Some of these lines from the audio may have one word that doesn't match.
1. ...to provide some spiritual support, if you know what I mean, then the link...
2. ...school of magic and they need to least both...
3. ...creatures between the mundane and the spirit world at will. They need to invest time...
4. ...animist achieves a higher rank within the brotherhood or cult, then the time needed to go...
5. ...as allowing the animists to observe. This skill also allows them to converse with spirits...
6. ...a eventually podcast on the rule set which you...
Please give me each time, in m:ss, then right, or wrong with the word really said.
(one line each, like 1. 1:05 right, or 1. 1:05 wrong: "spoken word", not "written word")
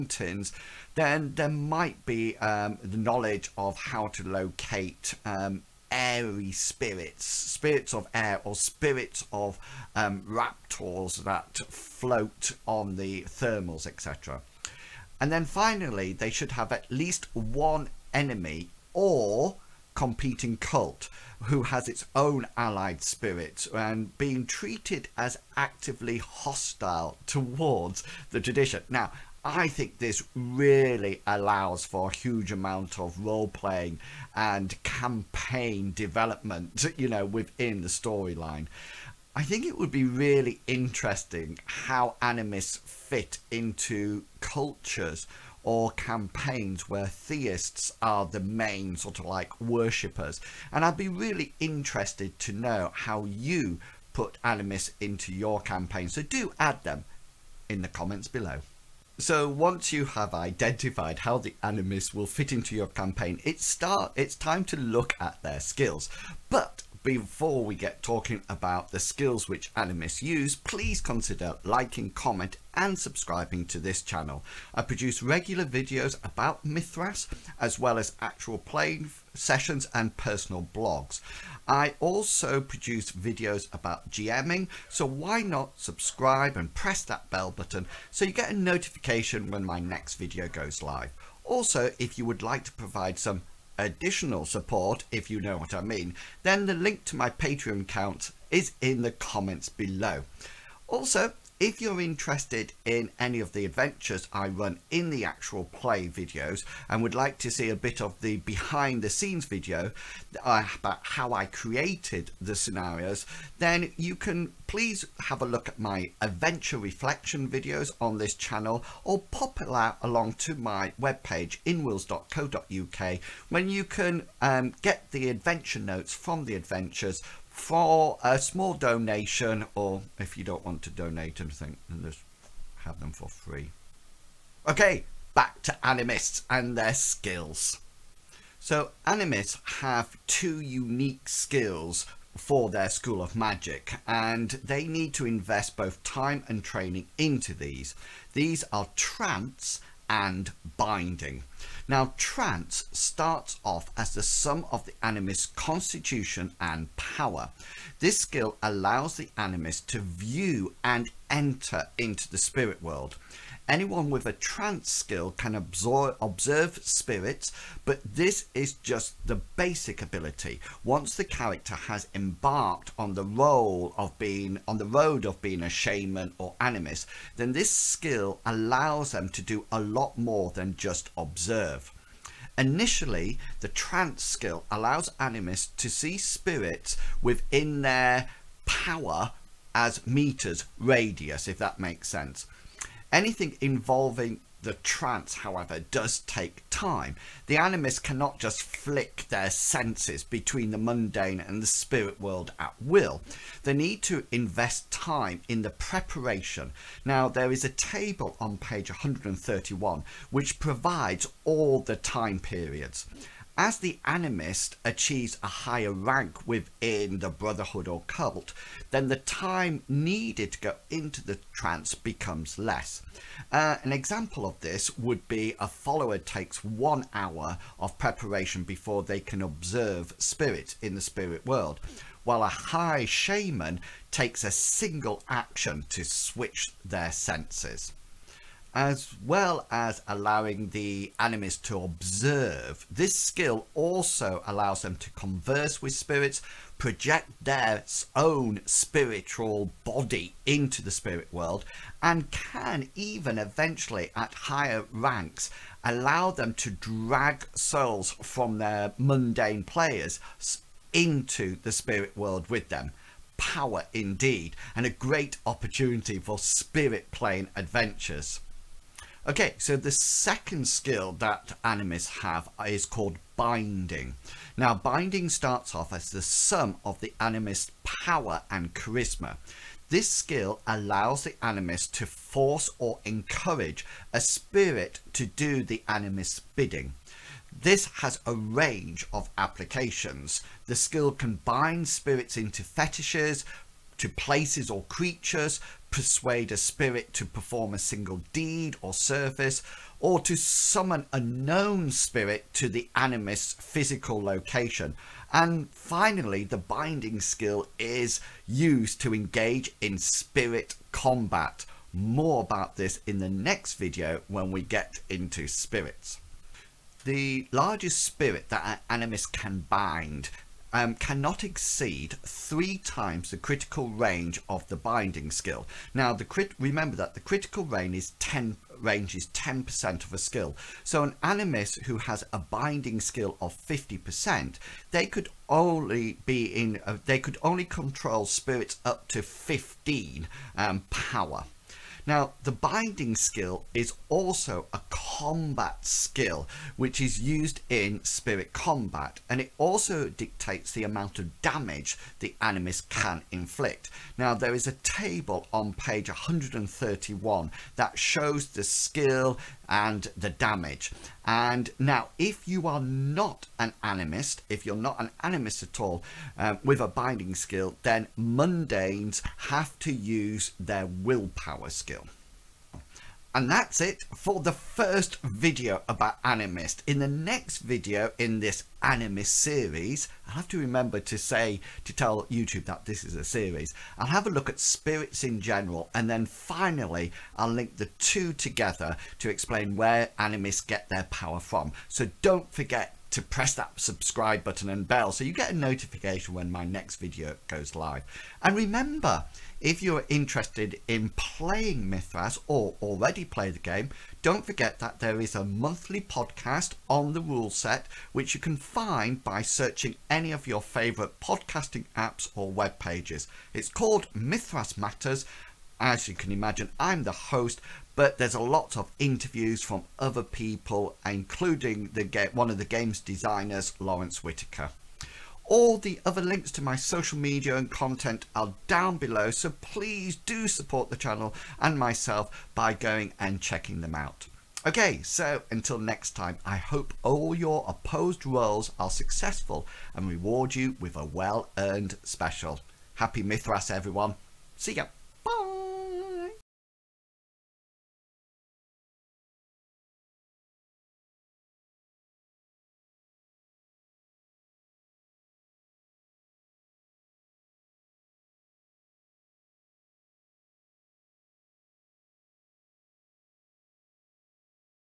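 1. 1:32 wrong: "additional", not "spiritual"
2. 2:22 wrong: "invest", not "least"
3. 3:19 wrong: "senses", not "creatures"
4. 3:34 right
5. 3:59 right
6. 6:45 wrong: "monthly", not "eventually".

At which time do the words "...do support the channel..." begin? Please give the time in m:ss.
7:10.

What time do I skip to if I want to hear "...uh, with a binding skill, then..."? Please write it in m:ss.
6:06.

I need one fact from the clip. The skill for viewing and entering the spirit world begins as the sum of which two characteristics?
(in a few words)
Constitution and power.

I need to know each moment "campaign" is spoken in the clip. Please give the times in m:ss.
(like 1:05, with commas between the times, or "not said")
0:34, 0:45, 0:55, 1:02.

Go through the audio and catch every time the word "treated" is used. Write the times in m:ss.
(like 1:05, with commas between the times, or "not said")
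0:24.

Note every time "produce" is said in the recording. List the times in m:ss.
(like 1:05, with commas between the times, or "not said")
1:14, 1:22.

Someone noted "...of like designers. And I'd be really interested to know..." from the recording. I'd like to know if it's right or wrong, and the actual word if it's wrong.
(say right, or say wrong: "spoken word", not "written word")
wrong: "worshippers", not "designers".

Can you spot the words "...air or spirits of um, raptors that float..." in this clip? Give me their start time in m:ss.
0:08.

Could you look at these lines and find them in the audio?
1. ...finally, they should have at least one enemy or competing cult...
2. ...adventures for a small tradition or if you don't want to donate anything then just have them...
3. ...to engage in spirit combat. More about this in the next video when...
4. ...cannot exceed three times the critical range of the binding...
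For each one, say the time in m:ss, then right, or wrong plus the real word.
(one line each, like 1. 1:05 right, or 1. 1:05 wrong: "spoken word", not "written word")
1. 0:15 right
2. 2:06 wrong: "donation", not "tradition"
3. 5:09 right
4. 5:20 right.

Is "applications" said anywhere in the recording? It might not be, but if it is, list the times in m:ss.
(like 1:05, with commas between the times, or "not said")
4:49.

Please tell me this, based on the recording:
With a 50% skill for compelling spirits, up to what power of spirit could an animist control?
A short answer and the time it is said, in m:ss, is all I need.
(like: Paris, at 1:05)
15, at 5:39.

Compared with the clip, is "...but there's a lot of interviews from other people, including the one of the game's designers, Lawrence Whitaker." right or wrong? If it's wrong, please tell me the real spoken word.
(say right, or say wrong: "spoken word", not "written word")
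right.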